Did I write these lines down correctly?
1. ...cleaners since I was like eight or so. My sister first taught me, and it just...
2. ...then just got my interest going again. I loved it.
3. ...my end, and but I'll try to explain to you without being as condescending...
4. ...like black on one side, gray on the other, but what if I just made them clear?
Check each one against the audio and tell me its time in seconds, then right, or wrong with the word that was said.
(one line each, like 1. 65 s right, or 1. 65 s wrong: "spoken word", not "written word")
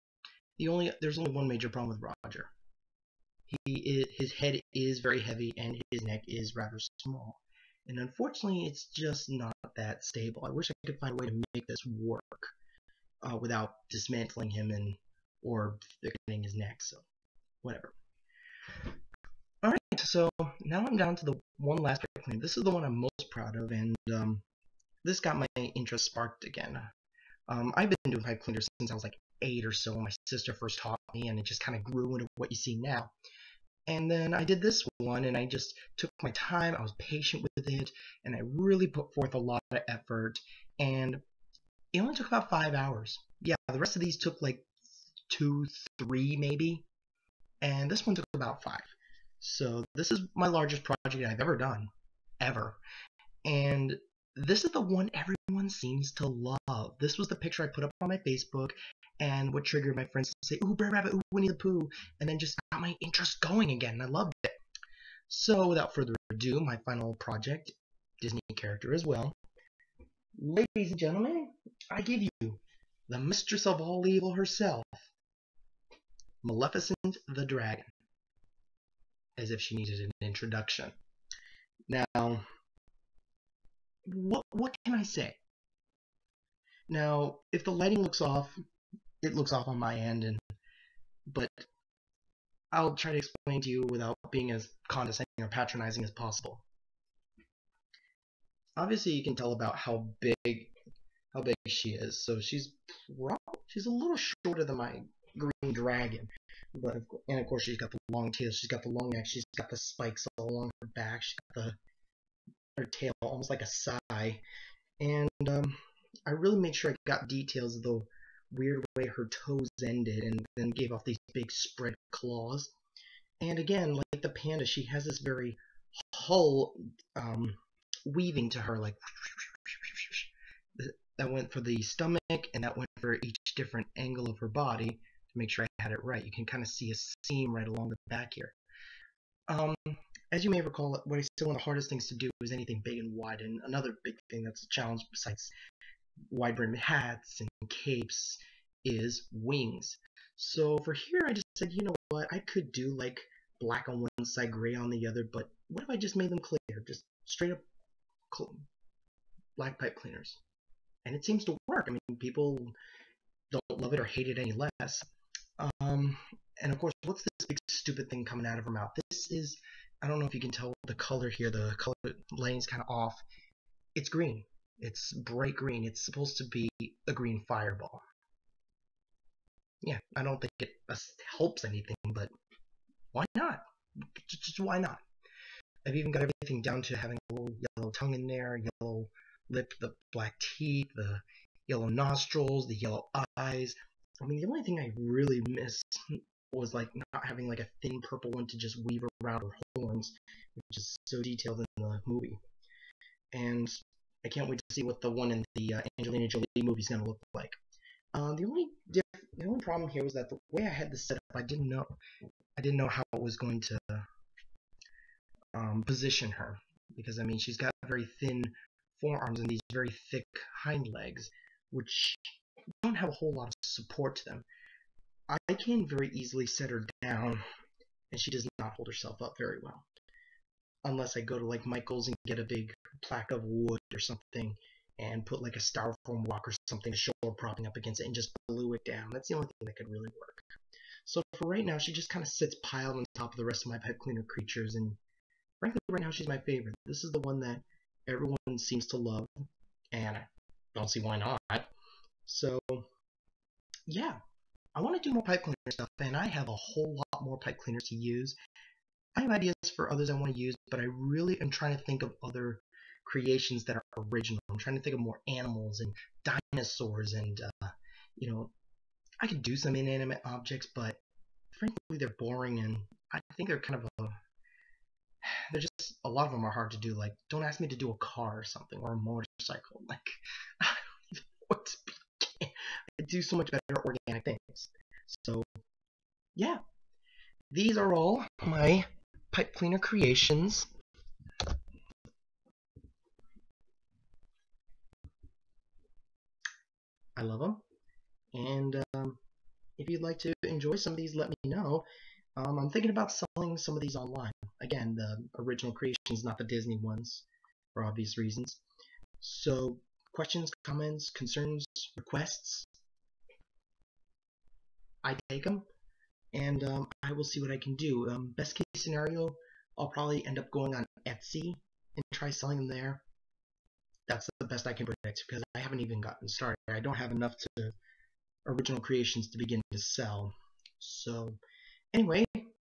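1. 28 s right
2. 62 s right
3. 89 s right
4. 152 s right.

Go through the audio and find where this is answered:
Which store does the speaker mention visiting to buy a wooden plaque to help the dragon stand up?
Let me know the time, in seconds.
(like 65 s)
231 s.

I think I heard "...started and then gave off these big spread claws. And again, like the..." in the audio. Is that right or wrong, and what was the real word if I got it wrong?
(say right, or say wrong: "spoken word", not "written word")
wrong: "ended", not "started".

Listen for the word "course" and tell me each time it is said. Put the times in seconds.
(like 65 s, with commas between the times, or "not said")
107 s, 166 s.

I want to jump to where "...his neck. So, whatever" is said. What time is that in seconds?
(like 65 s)
16 s.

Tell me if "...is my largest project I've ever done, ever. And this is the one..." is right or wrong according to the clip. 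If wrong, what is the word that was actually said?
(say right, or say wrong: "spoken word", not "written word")
right.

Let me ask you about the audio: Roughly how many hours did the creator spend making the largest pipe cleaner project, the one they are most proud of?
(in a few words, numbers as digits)
5.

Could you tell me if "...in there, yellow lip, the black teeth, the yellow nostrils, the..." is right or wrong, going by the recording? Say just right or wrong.
right.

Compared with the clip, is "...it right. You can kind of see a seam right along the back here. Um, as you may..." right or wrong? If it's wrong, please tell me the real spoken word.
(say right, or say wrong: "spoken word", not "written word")
right.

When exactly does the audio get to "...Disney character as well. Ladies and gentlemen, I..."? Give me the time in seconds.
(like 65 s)
68 s.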